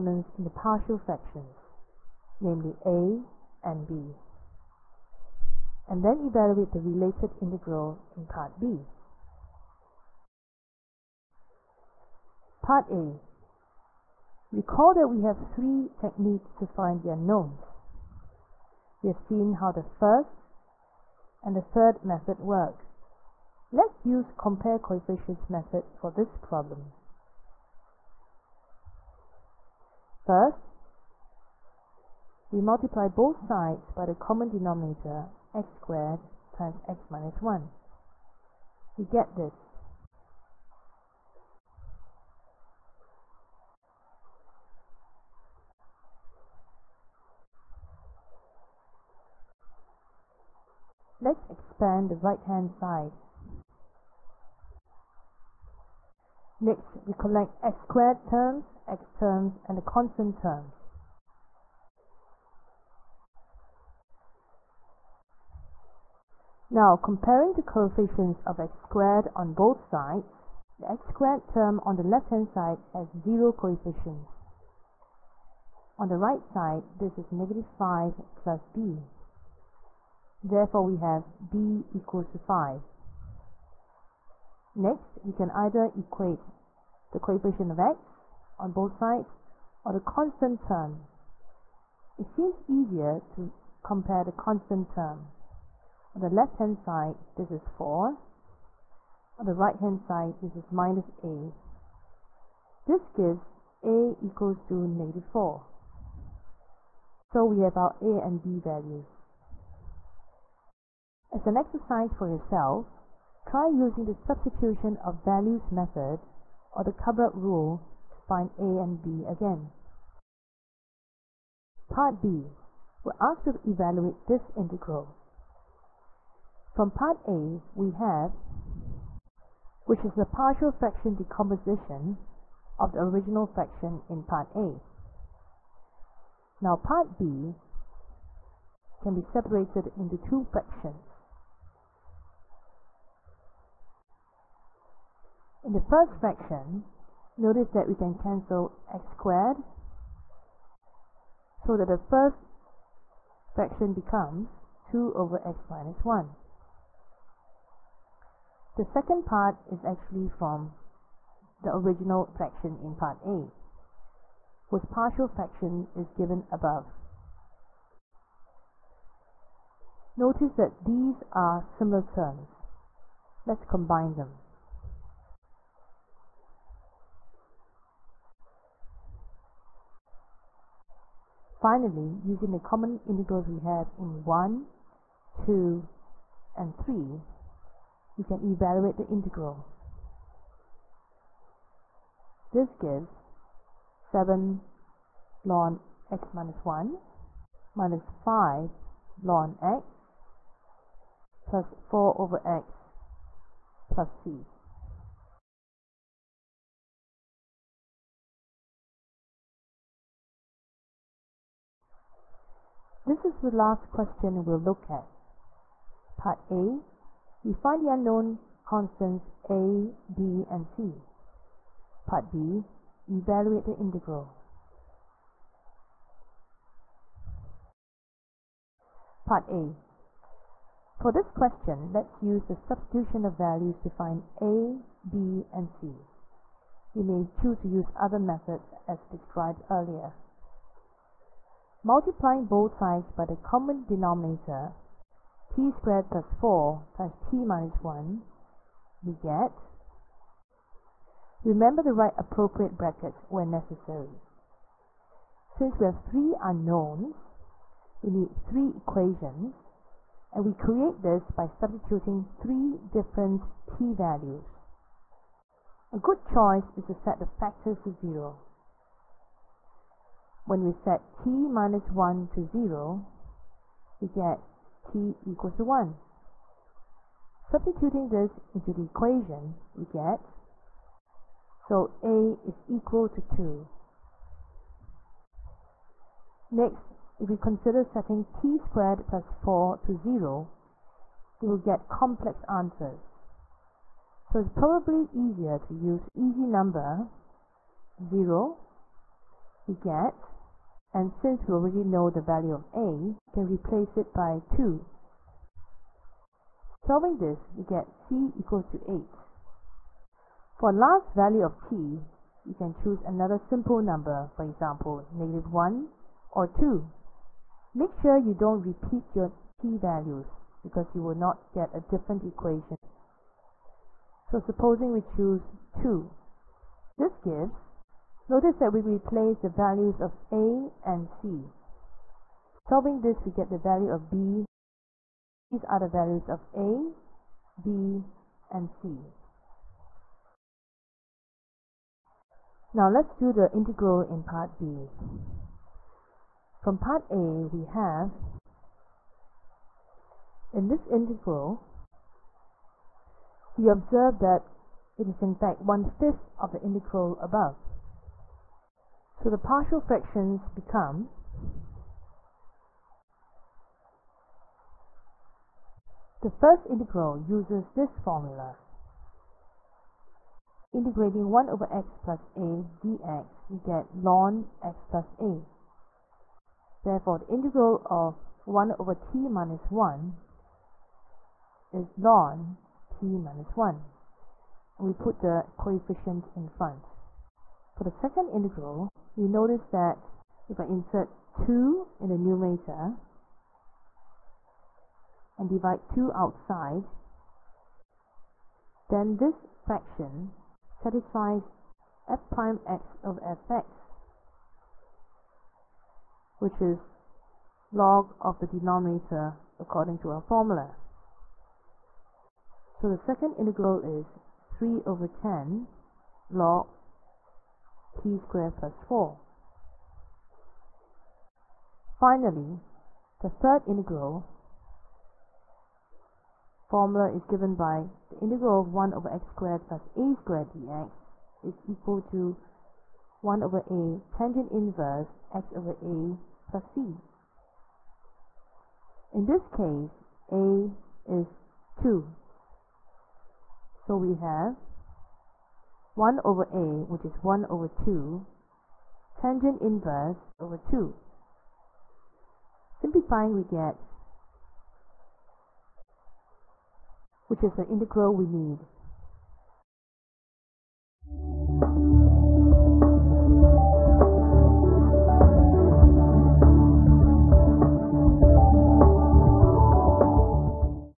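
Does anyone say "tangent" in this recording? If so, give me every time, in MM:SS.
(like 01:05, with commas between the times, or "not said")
07:14, 07:29.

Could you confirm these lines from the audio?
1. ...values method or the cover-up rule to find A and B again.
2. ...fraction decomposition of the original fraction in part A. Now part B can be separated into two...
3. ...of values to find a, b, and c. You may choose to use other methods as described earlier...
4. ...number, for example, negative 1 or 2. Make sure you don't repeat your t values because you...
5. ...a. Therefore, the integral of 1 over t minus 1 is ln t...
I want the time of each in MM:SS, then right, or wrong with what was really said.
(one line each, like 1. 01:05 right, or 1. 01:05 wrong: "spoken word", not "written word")
1. 01:55 right
2. 02:10 right
3. 03:53 right
4. 05:13 right
5. 06:15 right.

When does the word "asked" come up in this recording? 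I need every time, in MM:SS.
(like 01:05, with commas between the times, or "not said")
02:03.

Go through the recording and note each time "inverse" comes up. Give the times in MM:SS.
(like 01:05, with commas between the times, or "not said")
07:14, 07:29.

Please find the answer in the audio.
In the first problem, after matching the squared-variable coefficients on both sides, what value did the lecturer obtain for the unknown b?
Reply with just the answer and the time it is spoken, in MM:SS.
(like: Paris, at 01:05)
5, at 01:21.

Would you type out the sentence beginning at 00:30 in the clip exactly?
First, we multiply both sides by the common denominator x squared times x minus 1.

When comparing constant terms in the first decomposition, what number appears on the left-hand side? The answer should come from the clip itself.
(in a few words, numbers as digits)
4.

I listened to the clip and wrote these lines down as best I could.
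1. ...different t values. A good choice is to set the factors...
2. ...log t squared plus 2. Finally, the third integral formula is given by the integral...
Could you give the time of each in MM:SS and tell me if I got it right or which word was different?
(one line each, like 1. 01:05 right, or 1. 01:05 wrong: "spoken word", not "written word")
1. 04:22 right
2. 06:56 wrong: "4", not "2".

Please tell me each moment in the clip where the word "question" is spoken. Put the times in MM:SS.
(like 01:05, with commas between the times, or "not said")
03:33, 03:51.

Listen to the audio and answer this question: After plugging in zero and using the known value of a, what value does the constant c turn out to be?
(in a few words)
8.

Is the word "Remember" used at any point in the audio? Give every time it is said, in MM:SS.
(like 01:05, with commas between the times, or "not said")
04:11.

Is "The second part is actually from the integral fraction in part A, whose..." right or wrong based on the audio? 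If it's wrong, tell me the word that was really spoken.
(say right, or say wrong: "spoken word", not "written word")
wrong: "original", not "integral".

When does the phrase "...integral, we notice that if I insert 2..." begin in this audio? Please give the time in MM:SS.
06:28.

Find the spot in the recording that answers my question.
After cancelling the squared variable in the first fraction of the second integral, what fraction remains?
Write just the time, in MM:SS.
02:34.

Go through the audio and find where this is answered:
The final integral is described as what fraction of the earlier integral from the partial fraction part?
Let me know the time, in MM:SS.
05:55.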